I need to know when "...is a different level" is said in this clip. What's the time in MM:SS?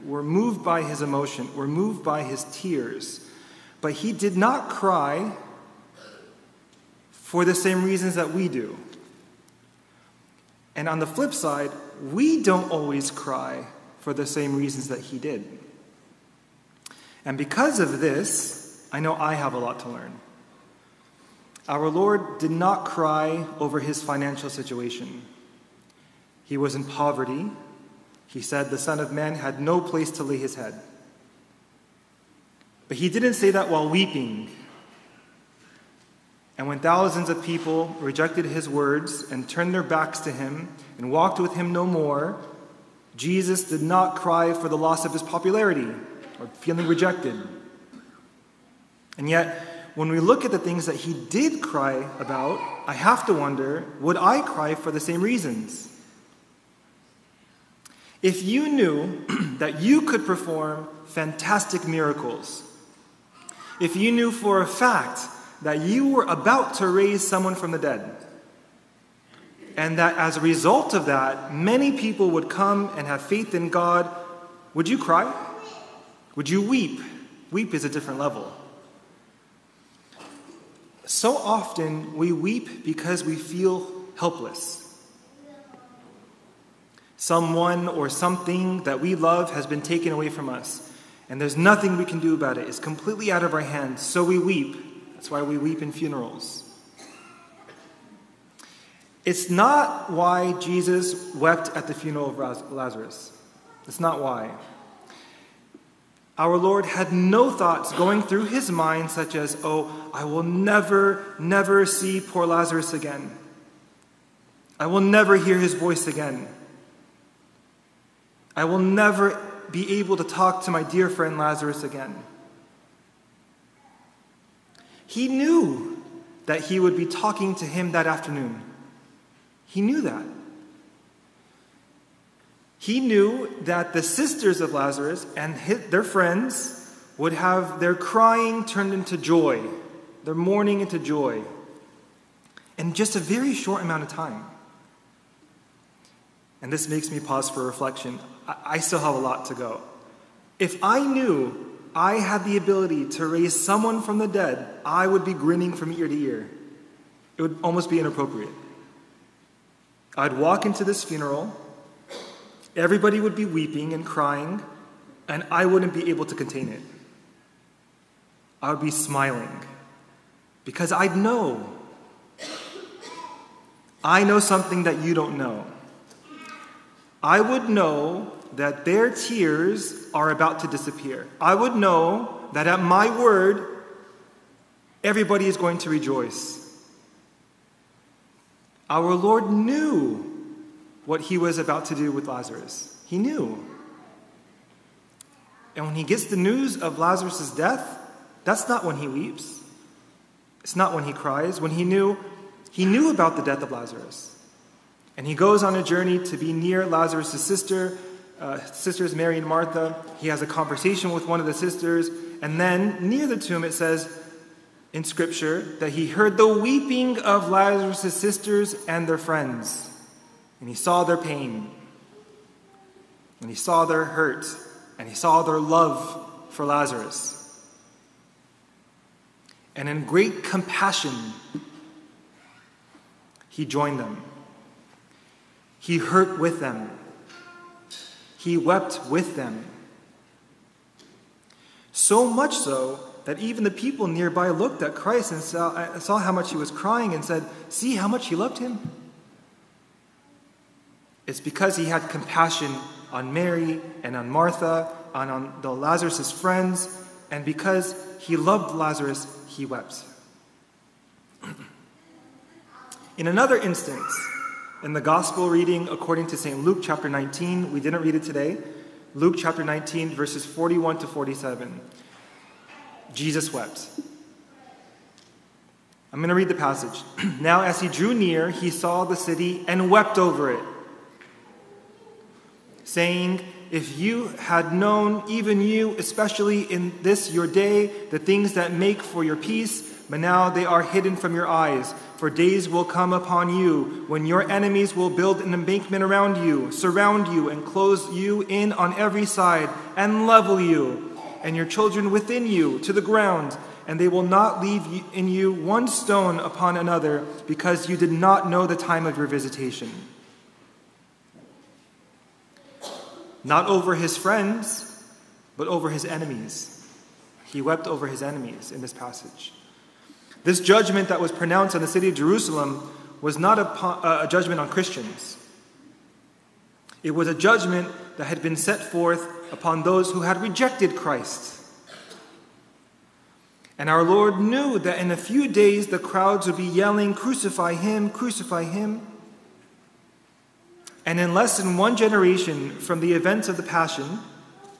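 01:17.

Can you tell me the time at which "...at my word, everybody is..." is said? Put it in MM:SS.
03:02.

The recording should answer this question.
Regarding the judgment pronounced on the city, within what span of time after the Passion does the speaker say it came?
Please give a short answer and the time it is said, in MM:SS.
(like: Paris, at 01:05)
Less than one generation, at 05:41.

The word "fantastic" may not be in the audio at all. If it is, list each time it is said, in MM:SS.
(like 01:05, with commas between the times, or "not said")
01:01.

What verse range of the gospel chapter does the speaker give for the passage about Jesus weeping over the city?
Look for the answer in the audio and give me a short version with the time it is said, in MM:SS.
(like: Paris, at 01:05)
41 to 47, at 04:30.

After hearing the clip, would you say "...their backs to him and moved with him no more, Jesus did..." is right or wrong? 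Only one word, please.
wrong.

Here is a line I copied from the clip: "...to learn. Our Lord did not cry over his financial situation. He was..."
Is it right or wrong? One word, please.
right.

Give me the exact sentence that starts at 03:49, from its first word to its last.
And in great compassion, he joined them.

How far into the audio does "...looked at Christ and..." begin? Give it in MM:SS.
04:04.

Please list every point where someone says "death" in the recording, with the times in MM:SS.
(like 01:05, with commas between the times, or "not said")
03:17, 03:23.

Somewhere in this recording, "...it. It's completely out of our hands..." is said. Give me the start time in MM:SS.
01:32.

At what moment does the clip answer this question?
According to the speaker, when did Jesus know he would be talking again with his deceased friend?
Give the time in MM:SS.
02:07.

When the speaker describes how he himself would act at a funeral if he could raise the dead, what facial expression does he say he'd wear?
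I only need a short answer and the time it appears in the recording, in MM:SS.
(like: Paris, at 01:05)
Grinning from ear to ear, at 02:35.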